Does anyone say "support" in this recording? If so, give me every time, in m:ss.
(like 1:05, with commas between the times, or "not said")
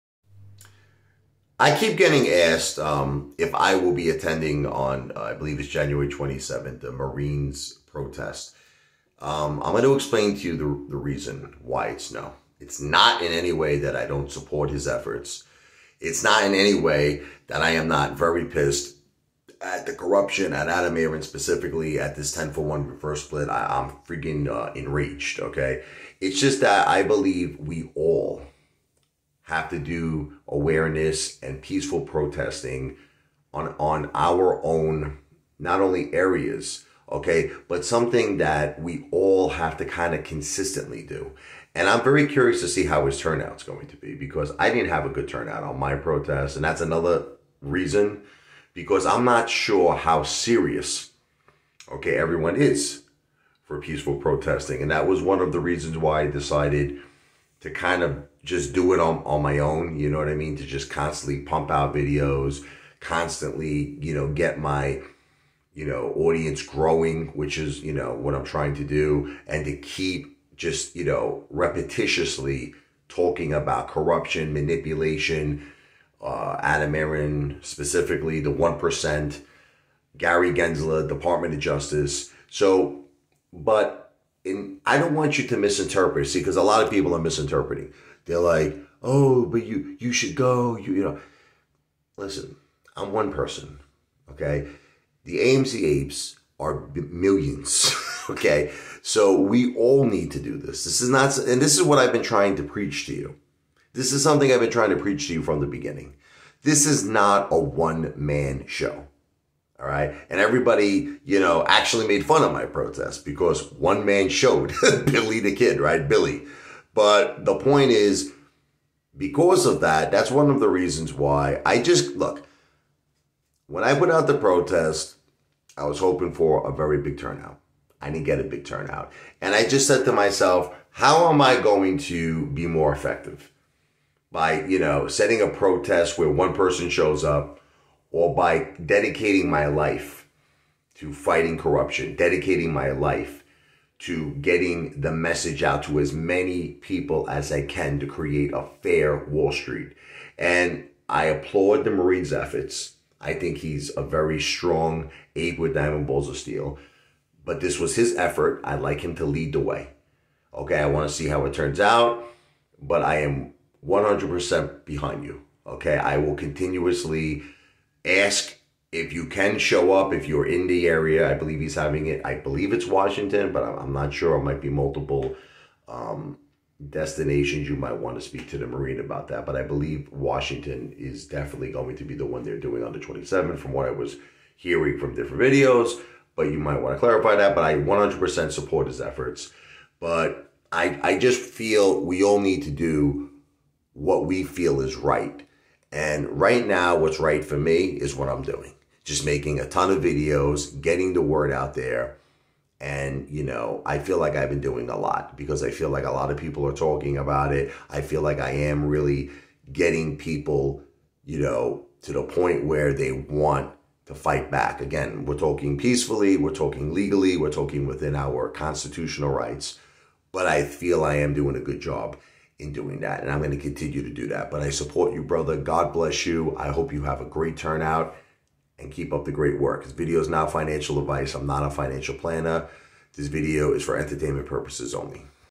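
0:14, 3:08, 3:44.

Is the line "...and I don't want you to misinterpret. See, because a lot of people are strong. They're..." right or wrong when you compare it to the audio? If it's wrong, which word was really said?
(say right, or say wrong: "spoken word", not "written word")
wrong: "misinterpreting", not "strong".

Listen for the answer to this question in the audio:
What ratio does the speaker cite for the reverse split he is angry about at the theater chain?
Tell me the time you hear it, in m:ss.
0:22.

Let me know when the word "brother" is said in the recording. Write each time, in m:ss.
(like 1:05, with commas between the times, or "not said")
3:45.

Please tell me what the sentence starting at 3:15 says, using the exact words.
And right now, what's right for me is what I'm doing.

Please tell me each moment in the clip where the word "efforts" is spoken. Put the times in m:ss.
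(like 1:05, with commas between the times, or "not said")
0:14, 2:32, 2:38, 3:08.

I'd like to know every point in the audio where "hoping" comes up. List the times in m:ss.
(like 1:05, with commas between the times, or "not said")
2:05.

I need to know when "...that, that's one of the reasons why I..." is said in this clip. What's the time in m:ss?
1:59.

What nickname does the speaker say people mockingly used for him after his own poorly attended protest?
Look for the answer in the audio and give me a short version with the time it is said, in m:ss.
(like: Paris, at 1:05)
Billy the Kid, at 1:55.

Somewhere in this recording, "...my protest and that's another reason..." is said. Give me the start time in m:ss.
0:45.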